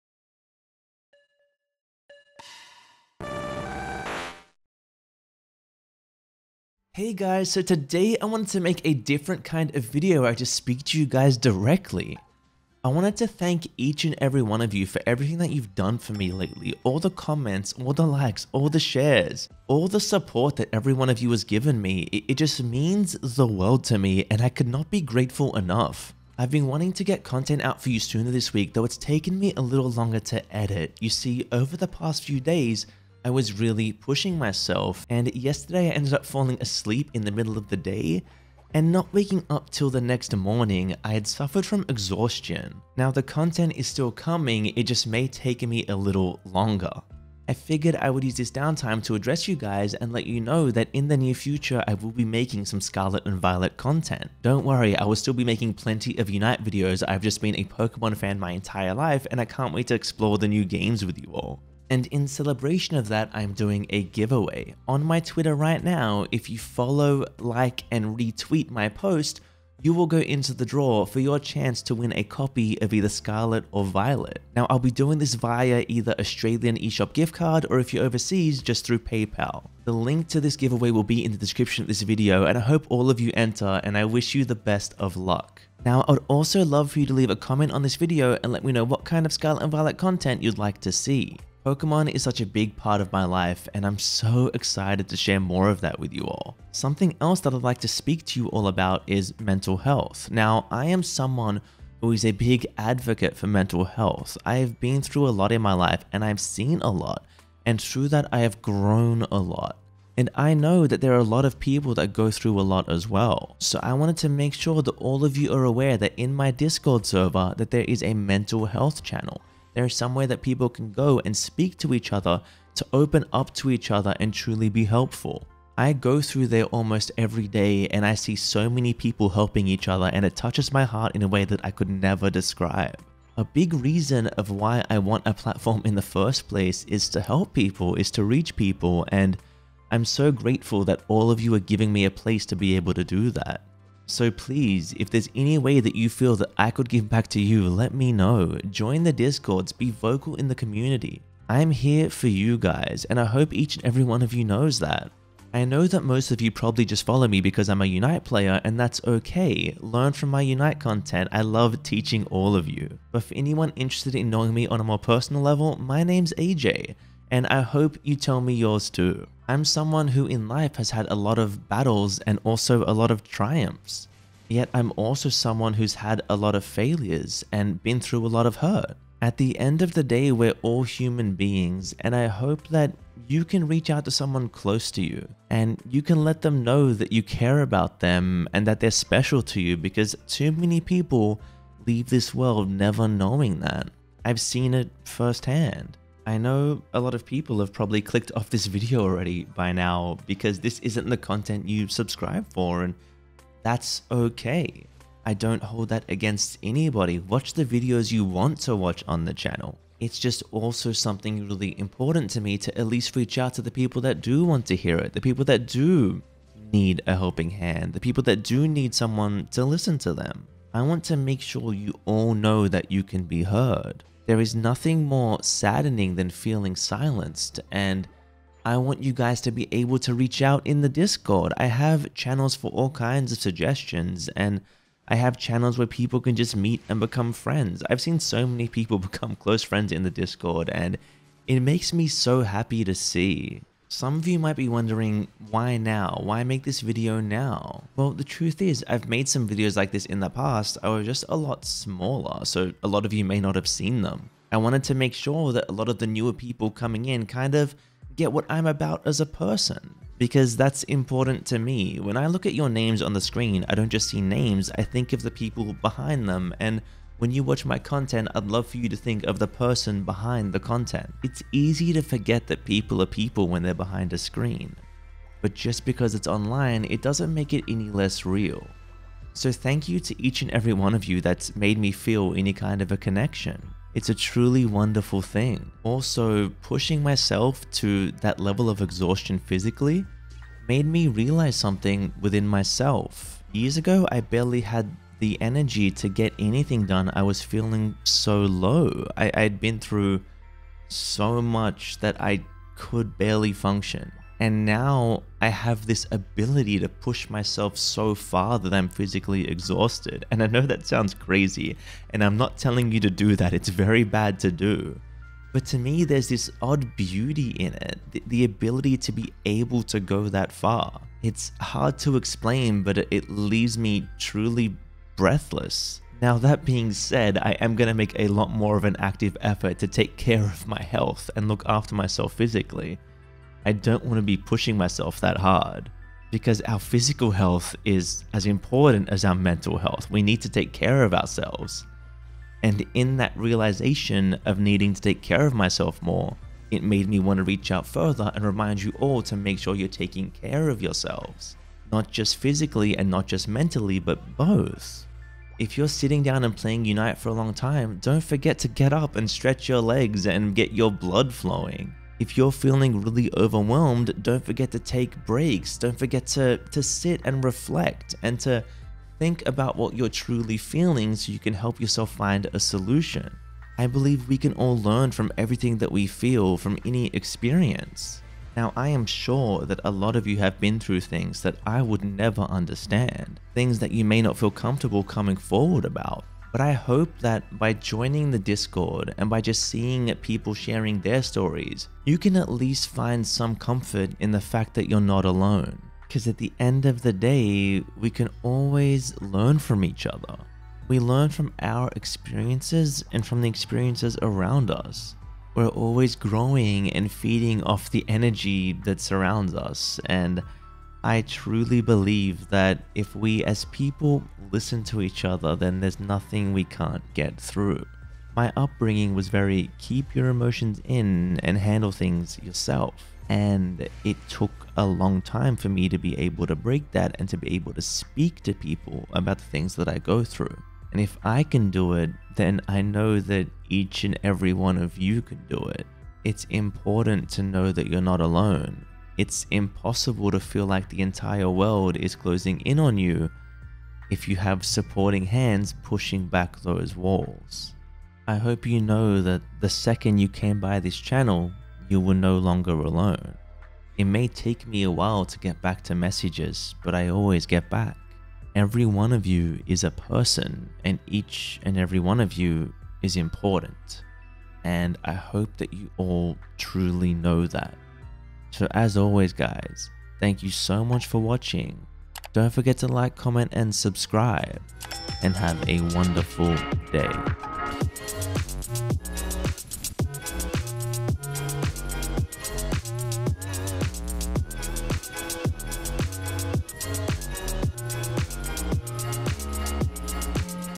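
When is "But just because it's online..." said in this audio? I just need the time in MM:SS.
04:35.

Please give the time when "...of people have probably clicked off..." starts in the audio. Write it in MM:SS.
03:17.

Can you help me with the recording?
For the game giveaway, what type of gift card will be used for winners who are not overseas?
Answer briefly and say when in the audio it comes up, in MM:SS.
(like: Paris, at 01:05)
Australian eShop gift card, at 01:16.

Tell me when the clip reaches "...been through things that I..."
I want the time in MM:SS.
06:20.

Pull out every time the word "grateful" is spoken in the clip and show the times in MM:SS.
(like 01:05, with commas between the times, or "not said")
00:24, 02:20.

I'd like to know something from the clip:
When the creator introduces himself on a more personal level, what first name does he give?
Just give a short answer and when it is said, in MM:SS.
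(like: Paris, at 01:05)
AJ, at 02:46.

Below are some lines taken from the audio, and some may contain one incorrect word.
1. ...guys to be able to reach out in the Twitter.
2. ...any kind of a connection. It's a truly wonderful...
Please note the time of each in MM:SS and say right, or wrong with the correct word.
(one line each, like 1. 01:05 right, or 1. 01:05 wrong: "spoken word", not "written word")
1. 03:49 wrong: "Discord", not "Twitter"
2. 04:42 right.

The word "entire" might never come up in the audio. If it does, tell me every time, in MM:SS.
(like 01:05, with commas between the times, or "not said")
00:58, 07:21.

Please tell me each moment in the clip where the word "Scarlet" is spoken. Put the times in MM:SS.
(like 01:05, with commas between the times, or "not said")
00:52, 01:13, 01:29.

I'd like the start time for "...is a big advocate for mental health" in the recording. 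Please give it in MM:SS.
01:42.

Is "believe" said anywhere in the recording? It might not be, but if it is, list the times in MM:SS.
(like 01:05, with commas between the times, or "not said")
06:13, 06:51.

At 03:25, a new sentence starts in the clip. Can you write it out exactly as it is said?
I don't hold that against anybody.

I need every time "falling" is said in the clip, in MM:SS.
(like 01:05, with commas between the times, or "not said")
00:36.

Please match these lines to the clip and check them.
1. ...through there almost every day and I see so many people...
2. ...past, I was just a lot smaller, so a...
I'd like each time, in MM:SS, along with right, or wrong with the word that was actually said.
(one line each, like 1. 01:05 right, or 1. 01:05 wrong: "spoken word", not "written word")
1. 02:06 right
2. 04:10 right.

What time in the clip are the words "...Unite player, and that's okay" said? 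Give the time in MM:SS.
02:37.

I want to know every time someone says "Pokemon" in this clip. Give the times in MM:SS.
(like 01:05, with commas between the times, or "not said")
00:57, 01:31.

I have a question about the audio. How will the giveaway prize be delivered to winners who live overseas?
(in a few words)
PayPal.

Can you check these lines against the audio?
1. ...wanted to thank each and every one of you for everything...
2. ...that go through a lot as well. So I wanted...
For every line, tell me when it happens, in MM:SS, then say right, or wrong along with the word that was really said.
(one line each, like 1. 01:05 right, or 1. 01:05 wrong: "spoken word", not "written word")
1. 00:12 right
2. 01:51 right.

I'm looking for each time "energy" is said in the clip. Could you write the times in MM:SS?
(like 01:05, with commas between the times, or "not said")
04:55, 06:48.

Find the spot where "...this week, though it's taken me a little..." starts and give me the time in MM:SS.
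00:28.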